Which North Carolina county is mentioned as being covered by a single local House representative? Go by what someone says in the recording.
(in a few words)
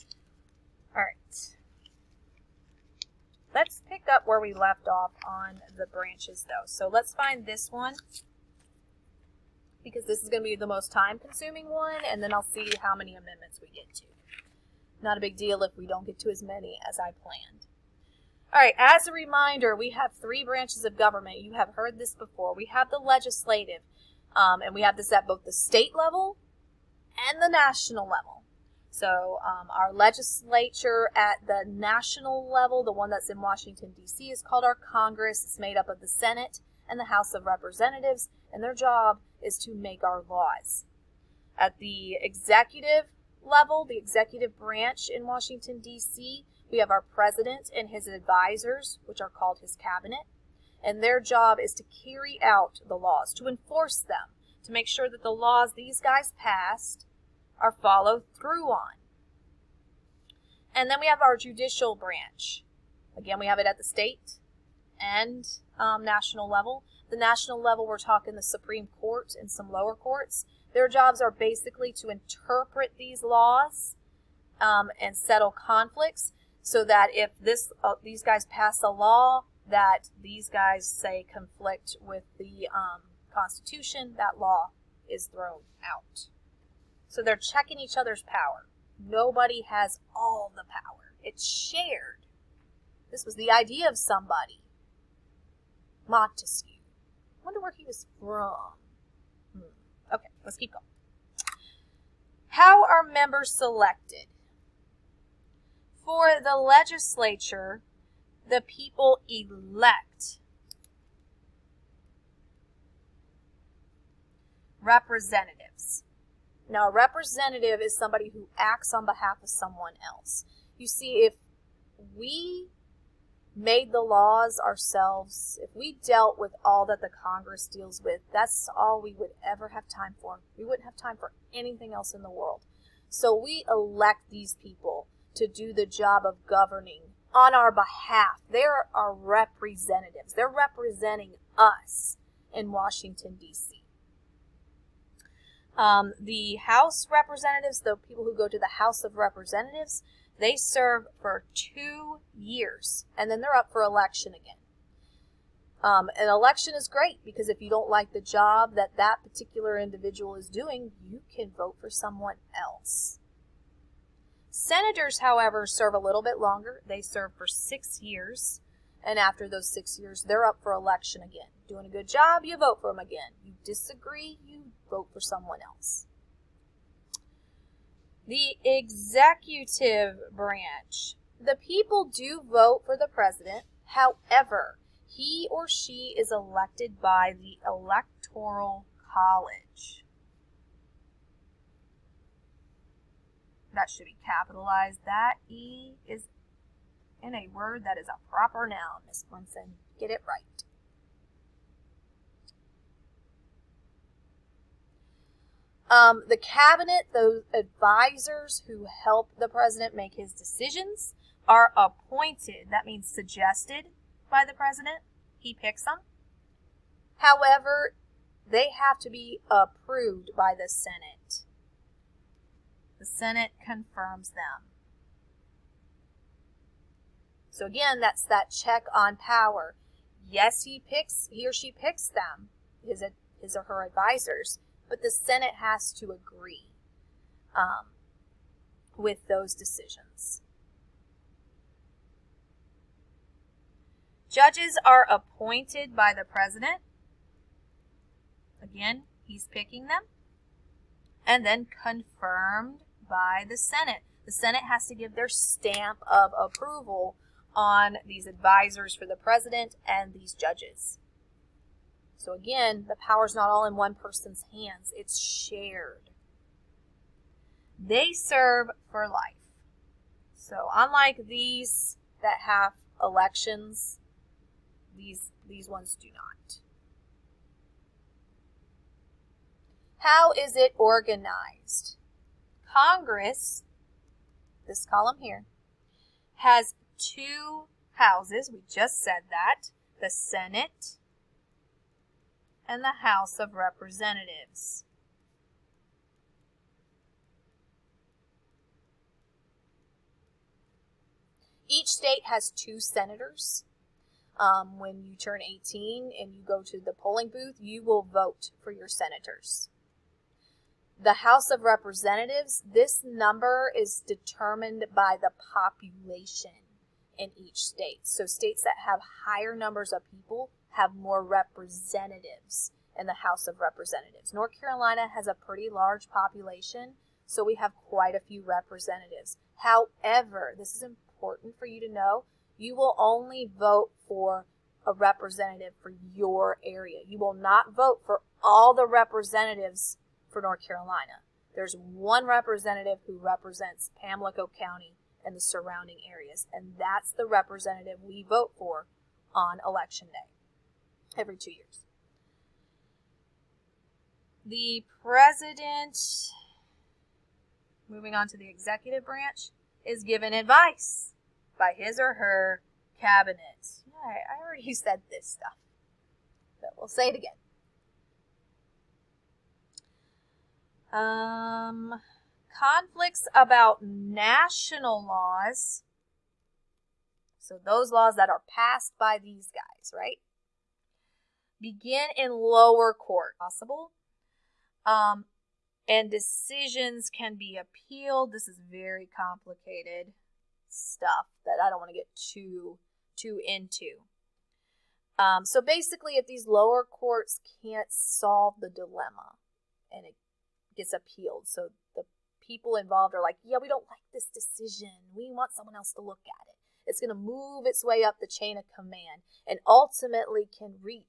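Pamlico County.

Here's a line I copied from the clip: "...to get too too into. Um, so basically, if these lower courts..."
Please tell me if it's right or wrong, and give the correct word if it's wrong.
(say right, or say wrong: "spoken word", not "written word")
right.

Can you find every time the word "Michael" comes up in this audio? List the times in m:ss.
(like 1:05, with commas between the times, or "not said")
not said.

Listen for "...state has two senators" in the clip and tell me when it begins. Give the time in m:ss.
5:01.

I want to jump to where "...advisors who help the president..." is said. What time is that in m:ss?
3:27.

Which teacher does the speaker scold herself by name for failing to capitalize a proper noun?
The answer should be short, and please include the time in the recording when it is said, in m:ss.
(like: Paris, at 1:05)
Miss Winston, at 3:19.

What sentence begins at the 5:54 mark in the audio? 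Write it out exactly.
The president, moving on to the executive branch, is given advice by his or her cabinet.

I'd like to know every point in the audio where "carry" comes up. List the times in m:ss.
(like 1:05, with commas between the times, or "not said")
0:51.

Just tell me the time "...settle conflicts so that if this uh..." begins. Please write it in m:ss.
1:15.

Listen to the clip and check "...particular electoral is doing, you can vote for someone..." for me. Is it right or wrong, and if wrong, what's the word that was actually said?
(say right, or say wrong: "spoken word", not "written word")
wrong: "individual", not "electoral".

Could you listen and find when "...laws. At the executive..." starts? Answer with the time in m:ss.
0:40.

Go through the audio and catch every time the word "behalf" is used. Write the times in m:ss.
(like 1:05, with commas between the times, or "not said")
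1:59, 2:17.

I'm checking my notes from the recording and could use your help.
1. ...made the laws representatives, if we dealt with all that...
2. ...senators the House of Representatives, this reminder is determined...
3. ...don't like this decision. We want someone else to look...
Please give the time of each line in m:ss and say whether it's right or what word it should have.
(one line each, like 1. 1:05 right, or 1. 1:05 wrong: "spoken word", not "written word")
1. 2:03 wrong: "ourselves", not "representatives"
2. 5:08 wrong: "number", not "reminder"
3. 6:43 right.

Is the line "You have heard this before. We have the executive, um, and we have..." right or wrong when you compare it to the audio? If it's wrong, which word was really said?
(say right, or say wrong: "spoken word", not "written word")
wrong: "legislative", not "executive".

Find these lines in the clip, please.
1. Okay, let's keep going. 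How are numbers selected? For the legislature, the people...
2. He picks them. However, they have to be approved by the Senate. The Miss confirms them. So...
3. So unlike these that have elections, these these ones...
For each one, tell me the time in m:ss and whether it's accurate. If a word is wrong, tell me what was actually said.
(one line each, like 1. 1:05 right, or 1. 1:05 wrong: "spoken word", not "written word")
1. 1:40 wrong: "members", not "numbers"
2. 3:35 wrong: "Senate", not "Miss"
3. 4:30 right.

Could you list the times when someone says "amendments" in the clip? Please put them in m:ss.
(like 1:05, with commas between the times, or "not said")
0:13.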